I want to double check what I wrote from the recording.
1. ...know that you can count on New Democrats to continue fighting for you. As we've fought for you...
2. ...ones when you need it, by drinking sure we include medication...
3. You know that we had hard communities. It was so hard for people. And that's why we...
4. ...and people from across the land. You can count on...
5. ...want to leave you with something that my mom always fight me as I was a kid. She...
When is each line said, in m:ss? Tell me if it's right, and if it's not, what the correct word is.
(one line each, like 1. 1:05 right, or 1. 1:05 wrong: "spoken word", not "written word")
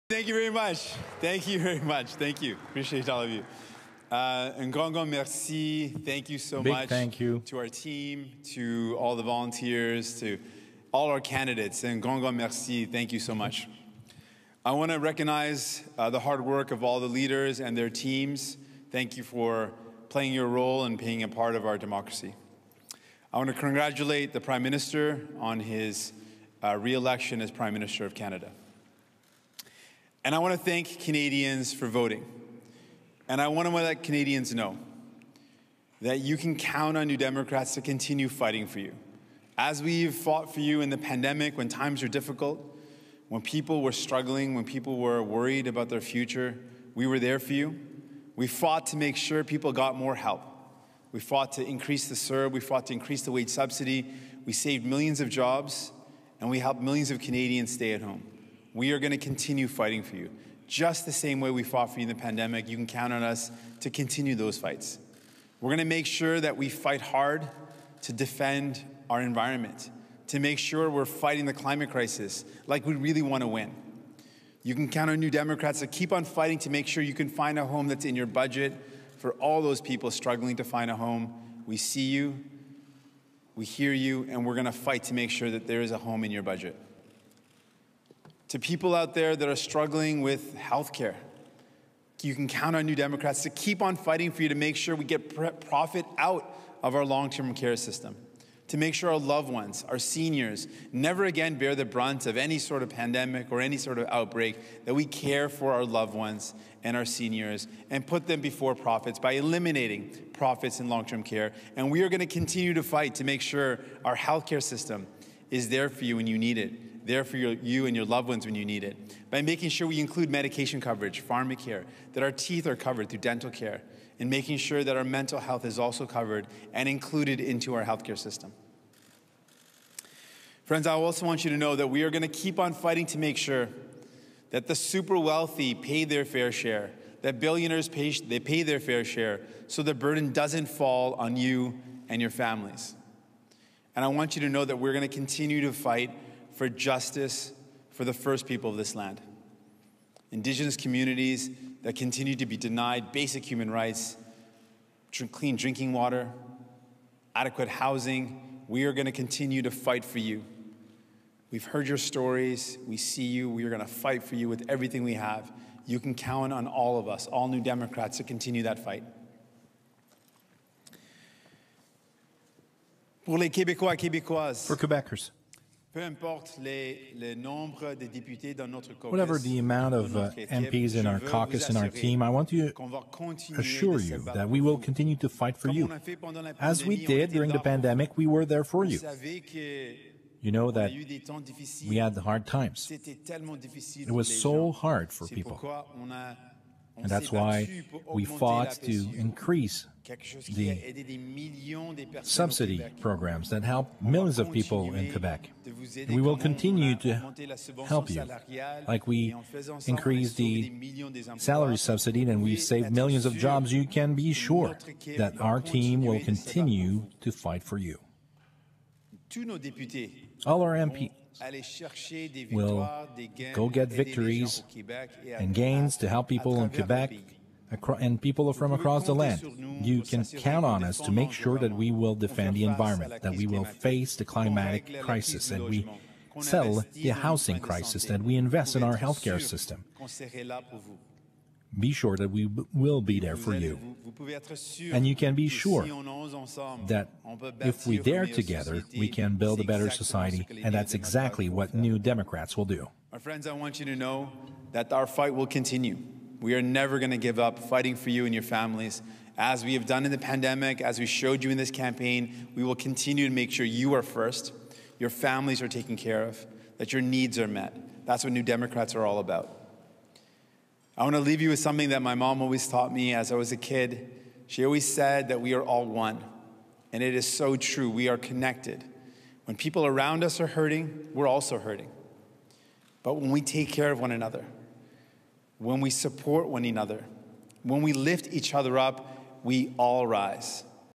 1. 0:34 right
2. 1:58 wrong: "making", not "drinking"
3. 3:10 wrong: "times", not "communities"
4. 3:47 right
5. 4:31 wrong: "taught", not "fight".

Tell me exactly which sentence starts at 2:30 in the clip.
Indigenous communities that continue to be denied basic human rights, clean drinking water, adequate housing.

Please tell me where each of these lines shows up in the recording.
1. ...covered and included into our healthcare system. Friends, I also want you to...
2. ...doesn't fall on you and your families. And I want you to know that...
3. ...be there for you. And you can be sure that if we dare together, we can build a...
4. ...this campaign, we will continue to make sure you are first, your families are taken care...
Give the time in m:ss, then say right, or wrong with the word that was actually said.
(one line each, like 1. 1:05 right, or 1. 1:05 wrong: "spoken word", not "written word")
1. 2:06 right
2. 2:20 right
3. 4:03 right
4. 4:21 right.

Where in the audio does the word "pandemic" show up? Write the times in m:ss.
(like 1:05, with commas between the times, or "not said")
0:40, 1:02, 1:42, 3:07, 4:20.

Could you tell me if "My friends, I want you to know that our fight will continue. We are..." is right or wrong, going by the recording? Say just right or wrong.
right.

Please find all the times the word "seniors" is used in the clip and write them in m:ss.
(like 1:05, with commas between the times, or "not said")
1:39, 1:47.